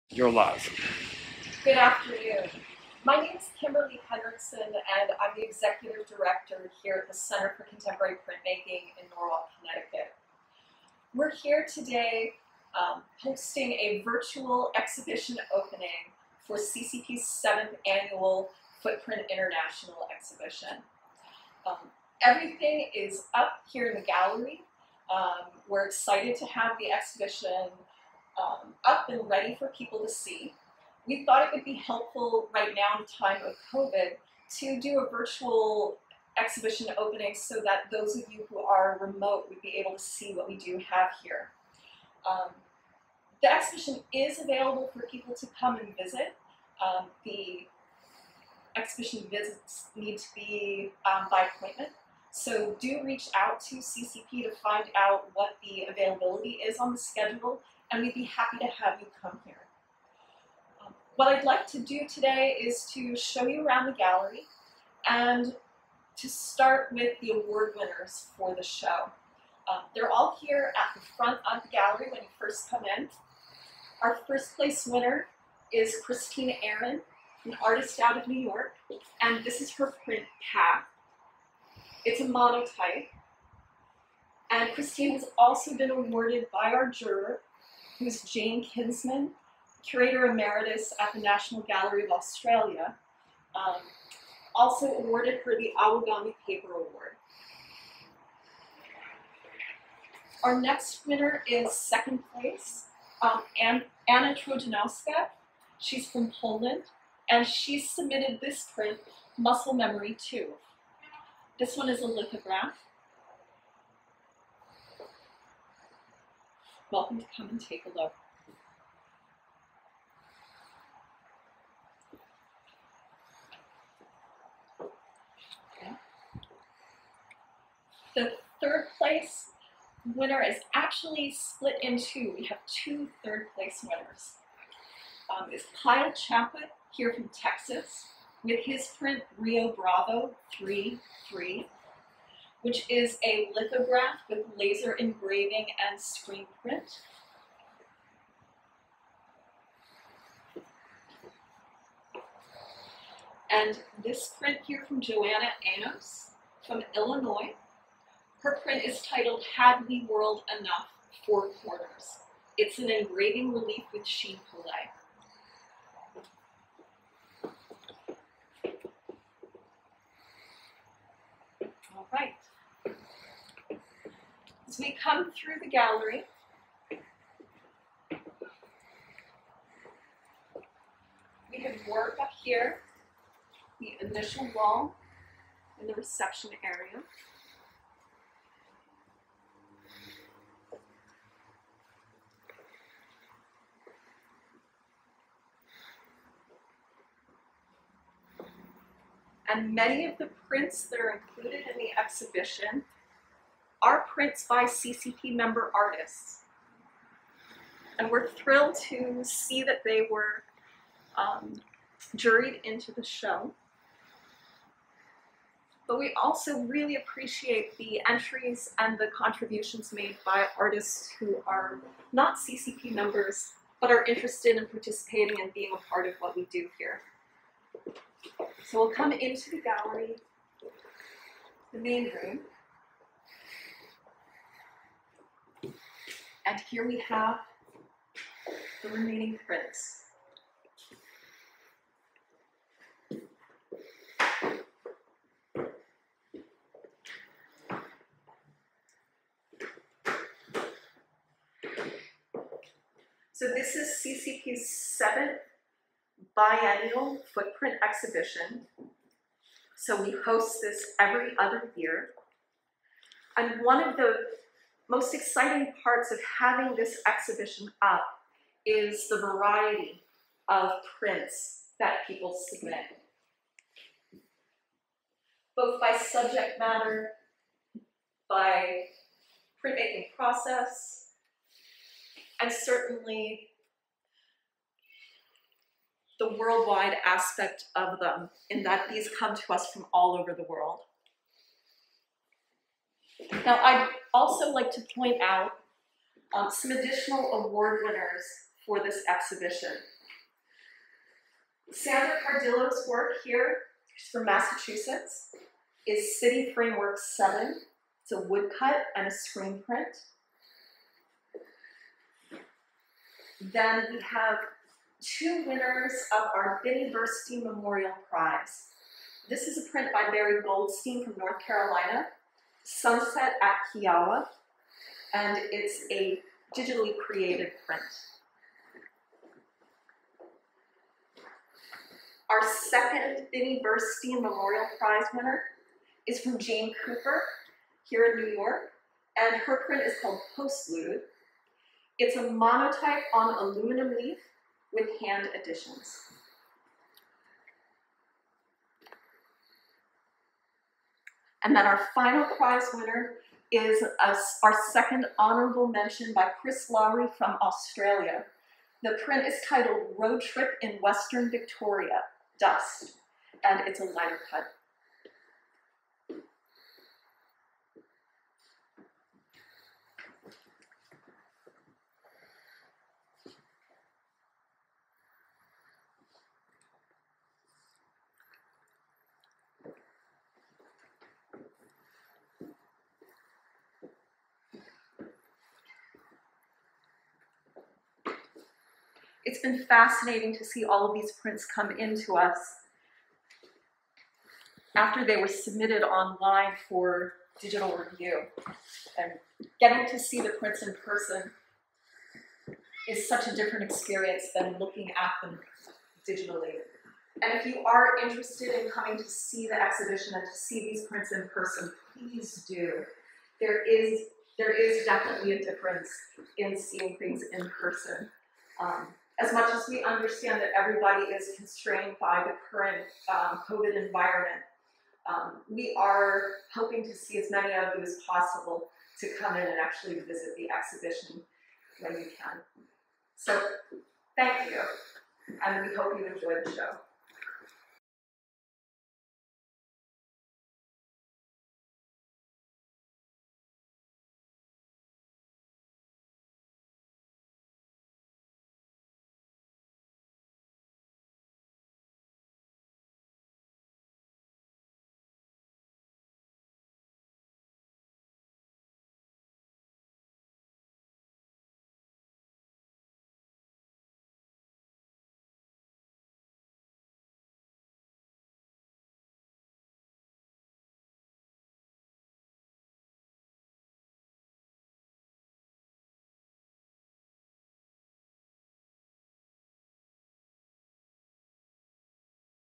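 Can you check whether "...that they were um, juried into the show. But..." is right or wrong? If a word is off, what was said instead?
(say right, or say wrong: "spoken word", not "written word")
right.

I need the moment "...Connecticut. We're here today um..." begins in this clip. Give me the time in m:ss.
0:09.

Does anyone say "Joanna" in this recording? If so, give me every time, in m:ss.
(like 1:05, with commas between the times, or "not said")
2:35.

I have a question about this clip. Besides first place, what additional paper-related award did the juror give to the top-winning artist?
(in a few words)
Awagami Paper Award.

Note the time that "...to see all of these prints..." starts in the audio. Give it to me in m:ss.
6:30.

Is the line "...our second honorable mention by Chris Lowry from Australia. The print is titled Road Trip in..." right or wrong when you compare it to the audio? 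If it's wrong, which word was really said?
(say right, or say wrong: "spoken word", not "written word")
right.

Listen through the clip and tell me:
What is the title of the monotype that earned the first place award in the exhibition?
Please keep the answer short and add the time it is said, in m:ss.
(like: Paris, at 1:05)
Path, at 1:20.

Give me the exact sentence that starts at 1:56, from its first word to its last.
welcome to come and take a look.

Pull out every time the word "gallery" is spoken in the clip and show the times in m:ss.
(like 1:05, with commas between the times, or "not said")
0:24, 1:03, 1:11, 1:31, 2:55, 3:49.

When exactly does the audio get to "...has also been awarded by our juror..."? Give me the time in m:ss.
1:25.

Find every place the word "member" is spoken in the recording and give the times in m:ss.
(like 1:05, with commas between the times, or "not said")
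3:25, 3:42.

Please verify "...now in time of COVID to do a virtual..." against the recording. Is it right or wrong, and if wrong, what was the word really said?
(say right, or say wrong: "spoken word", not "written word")
right.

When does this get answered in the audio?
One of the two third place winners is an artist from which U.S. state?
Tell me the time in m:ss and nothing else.
2:17.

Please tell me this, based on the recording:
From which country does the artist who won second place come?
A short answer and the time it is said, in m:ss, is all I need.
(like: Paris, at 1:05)
Poland, at 1:46.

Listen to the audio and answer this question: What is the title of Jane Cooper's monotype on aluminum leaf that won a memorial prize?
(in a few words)
Postlude.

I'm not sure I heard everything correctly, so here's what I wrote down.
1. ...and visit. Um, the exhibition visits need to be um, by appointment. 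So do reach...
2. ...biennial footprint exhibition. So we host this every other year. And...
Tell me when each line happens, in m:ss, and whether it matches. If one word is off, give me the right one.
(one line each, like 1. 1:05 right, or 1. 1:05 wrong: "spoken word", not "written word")
1. 0:45 right
2. 4:16 right.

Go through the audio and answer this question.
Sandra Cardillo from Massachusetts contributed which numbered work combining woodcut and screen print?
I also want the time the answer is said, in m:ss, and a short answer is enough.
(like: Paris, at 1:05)
City Framework 7, at 5:06.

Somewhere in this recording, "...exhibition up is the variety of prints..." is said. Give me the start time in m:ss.
4:27.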